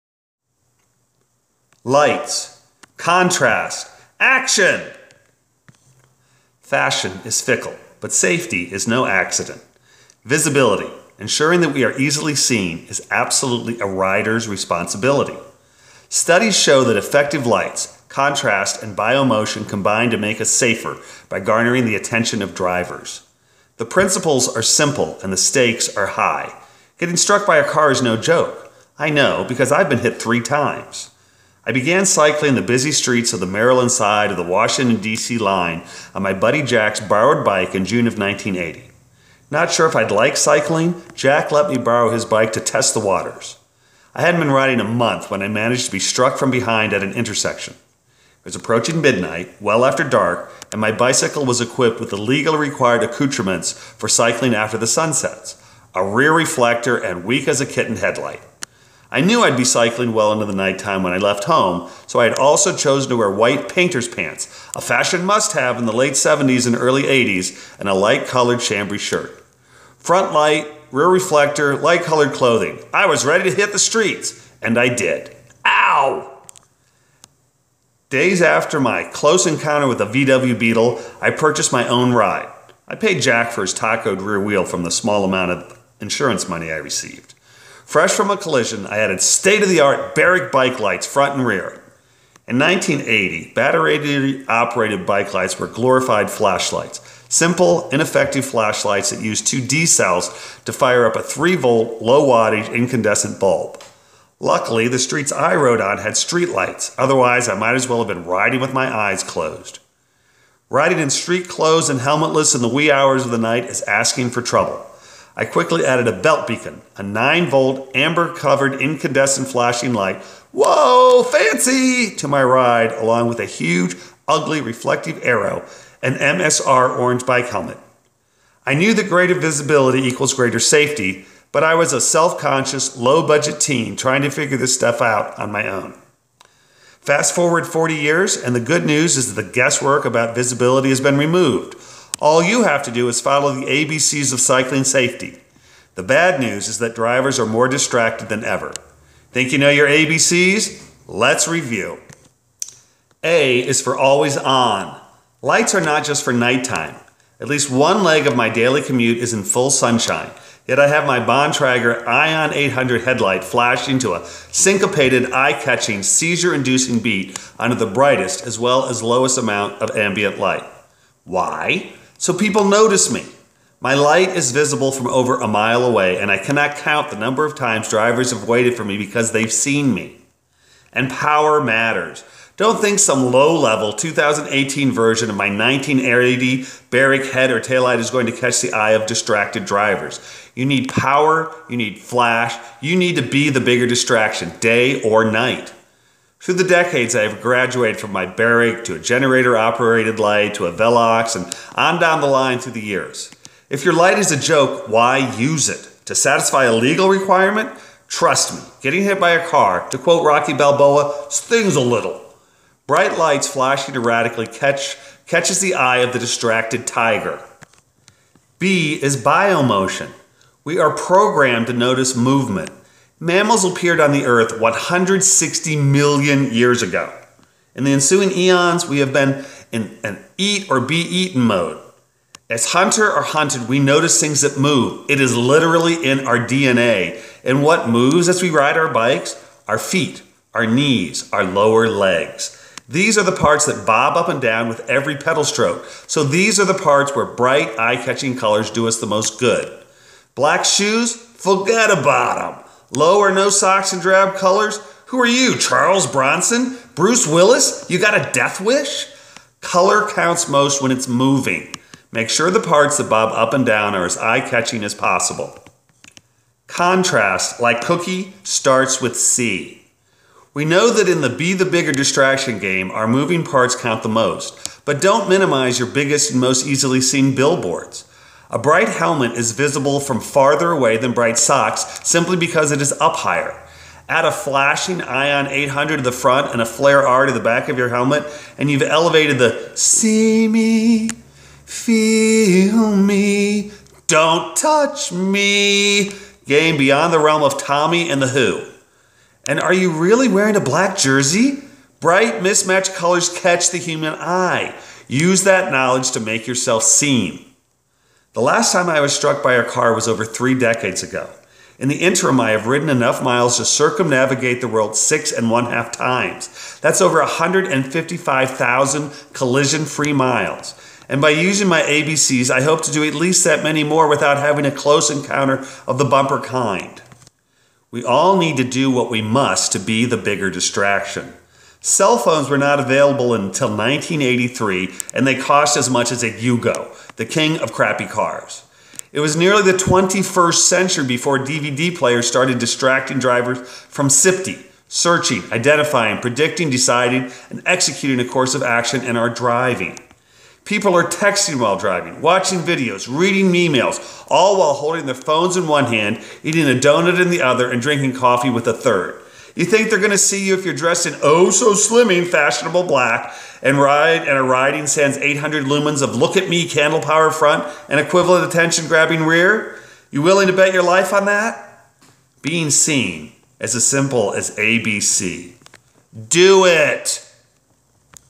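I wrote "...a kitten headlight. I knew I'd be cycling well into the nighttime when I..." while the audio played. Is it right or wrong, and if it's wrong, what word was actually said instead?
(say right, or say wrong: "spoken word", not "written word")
right.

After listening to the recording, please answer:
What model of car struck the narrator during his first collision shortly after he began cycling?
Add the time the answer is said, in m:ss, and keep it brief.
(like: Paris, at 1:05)
VW Beetle, at 1:20.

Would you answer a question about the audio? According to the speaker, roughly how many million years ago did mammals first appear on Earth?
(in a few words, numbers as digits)
160 million.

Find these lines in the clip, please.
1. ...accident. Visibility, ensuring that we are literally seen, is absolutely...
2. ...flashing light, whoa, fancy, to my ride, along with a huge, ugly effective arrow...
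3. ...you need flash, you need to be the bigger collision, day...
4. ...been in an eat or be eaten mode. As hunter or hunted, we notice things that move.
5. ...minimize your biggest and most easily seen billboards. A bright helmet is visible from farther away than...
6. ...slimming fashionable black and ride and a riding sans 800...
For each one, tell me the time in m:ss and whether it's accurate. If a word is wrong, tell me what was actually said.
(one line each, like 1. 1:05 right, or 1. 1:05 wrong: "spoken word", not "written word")
1. 0:09 wrong: "easily", not "literally"
2. 1:59 wrong: "reflective", not "effective"
3. 3:11 wrong: "distraction", not "collision"
4. 3:49 right
5. 4:35 right
6. 6:01 right.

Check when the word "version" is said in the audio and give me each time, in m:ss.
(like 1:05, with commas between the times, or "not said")
3:04.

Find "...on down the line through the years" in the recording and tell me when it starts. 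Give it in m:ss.
3:21.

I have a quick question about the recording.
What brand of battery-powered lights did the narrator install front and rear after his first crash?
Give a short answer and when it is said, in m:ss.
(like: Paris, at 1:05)
Barrick, at 1:30.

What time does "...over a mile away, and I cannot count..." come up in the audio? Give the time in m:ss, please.
2:55.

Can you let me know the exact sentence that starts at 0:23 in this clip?
The principles are simple and the stakes are high.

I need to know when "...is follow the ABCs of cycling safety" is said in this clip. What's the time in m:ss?
2:23.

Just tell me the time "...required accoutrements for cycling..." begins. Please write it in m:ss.
0:52.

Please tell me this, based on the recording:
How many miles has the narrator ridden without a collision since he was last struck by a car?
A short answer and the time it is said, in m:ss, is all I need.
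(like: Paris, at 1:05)
155,000, at 5:17.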